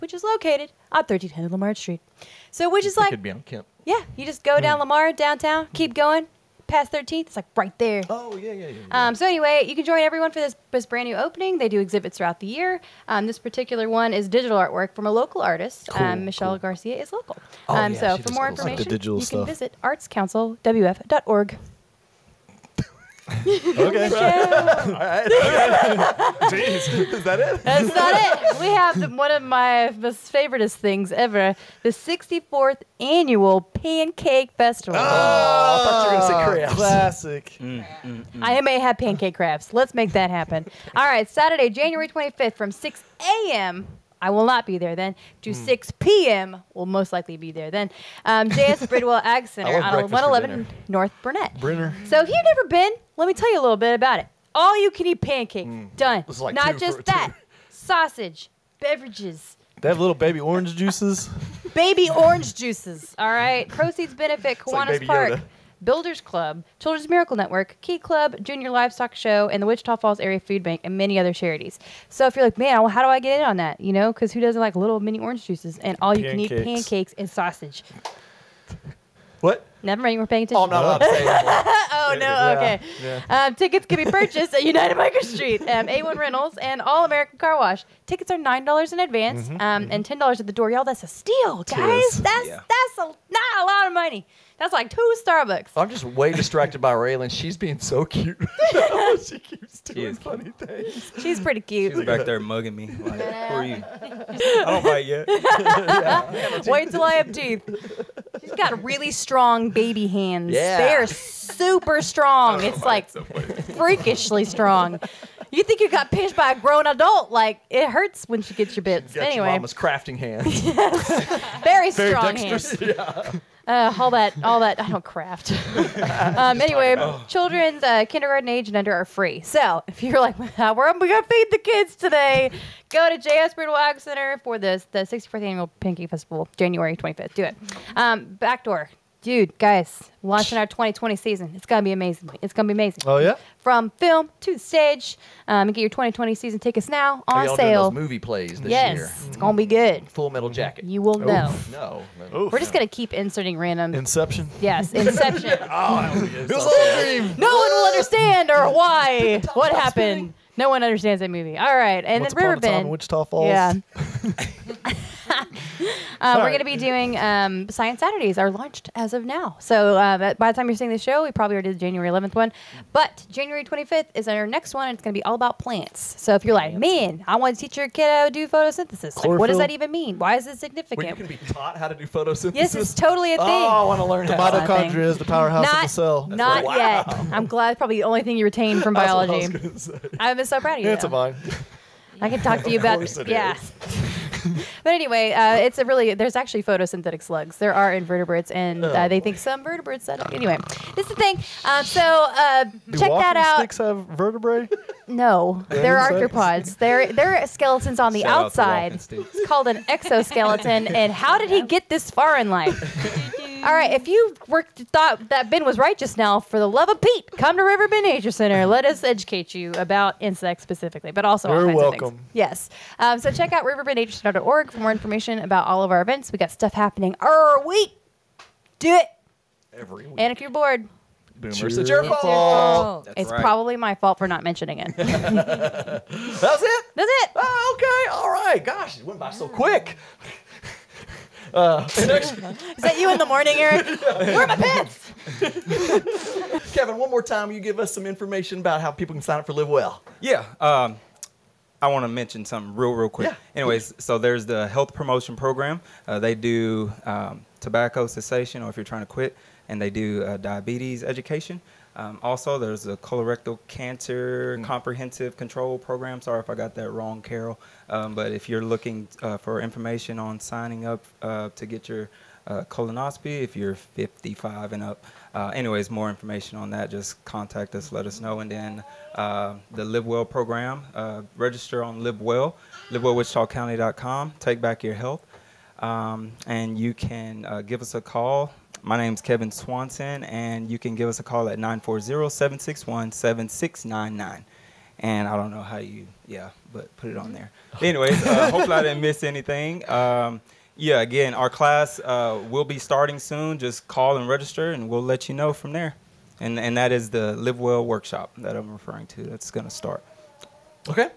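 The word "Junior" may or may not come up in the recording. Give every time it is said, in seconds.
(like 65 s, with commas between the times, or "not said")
68 s.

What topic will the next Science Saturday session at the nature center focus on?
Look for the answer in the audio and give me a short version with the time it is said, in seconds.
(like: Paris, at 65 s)
Plants, at 175 s.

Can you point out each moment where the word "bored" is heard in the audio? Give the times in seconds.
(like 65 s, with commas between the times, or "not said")
230 s.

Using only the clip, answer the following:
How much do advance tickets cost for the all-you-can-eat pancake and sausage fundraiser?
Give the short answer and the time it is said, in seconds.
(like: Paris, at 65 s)
$9, at 88 s.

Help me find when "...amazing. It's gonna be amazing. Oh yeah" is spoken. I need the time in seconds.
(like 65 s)
141 s.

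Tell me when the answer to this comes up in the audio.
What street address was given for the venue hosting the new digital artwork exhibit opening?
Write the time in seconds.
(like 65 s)
0 s.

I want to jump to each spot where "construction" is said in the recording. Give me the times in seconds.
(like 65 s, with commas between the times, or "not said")
not said.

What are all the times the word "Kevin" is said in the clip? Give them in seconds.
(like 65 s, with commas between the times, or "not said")
246 s, 289 s.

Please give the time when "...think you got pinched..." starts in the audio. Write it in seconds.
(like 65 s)
115 s.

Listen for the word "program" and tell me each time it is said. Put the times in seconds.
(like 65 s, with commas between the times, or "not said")
255 s, 265 s, 280 s.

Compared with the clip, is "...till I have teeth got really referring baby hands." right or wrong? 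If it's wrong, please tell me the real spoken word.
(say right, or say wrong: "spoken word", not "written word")
wrong: "strong", not "referring".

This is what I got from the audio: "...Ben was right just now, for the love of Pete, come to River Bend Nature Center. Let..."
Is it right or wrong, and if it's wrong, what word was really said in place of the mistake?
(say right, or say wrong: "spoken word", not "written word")
right.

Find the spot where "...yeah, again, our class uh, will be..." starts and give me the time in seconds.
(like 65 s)
300 s.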